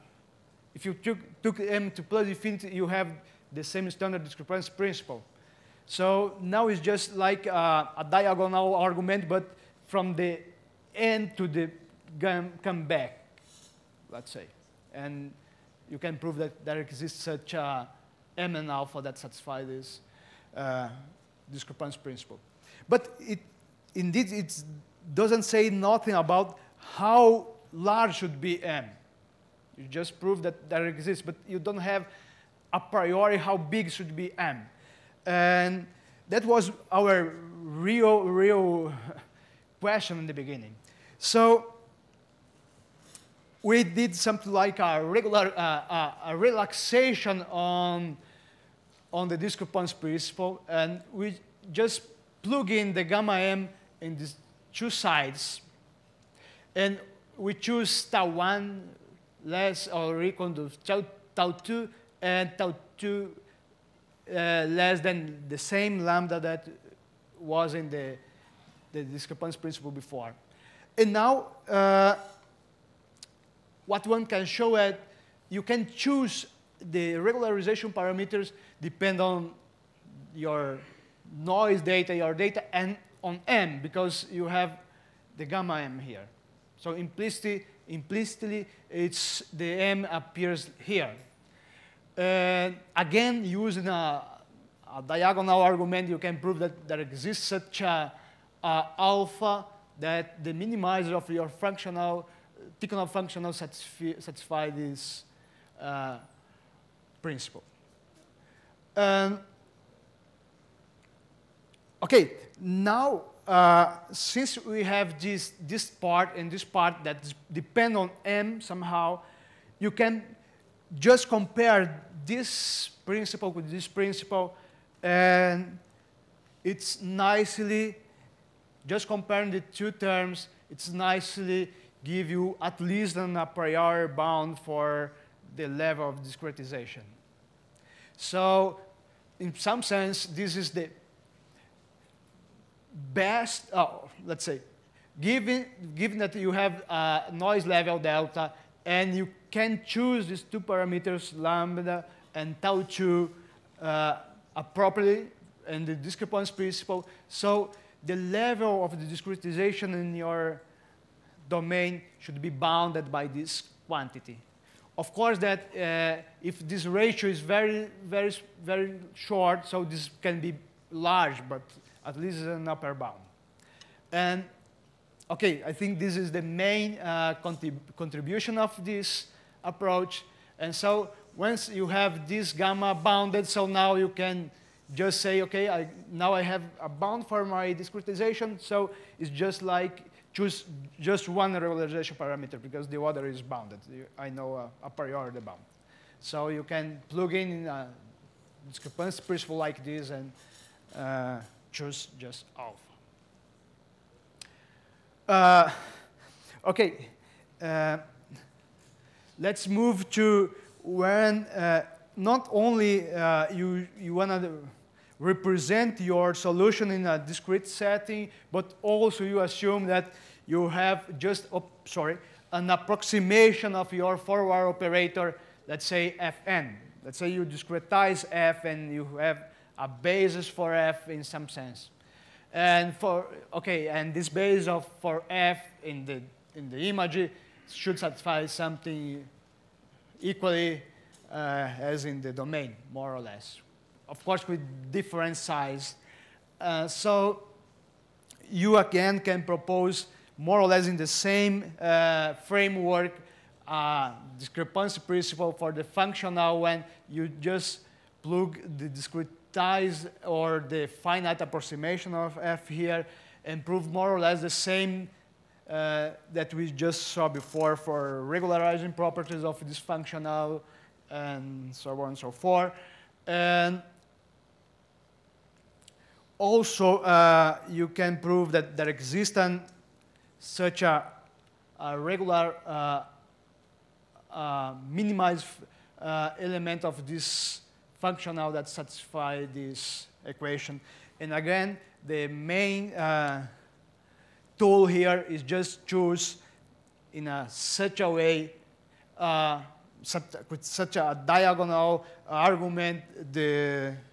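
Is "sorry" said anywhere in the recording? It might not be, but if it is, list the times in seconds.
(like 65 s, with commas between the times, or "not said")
221 s.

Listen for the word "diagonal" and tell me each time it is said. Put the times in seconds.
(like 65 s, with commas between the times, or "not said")
8 s, 95 s, 301 s.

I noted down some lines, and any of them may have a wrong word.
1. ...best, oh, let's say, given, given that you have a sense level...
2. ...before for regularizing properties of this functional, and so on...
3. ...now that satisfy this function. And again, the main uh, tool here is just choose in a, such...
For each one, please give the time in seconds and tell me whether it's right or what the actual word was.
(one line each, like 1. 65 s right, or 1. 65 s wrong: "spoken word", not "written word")
1. 143 s wrong: "noise", not "sense"
2. 267 s right
3. 288 s wrong: "equation", not "function".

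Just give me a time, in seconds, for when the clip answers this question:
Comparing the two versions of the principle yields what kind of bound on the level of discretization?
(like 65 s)
133 s.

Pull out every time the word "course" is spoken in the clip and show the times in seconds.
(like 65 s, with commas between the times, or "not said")
165 s, 244 s.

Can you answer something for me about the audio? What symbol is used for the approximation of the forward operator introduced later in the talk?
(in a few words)
Fn.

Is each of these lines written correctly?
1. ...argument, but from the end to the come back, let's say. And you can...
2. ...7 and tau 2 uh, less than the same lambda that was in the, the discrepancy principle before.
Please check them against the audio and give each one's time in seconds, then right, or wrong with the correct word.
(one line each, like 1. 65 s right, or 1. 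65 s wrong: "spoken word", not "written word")
1. 8 s right
2. 61 s wrong: "2", not "7".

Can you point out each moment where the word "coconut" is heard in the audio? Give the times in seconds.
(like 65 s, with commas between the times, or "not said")
not said.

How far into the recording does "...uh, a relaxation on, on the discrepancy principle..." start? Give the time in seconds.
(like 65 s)
45 s.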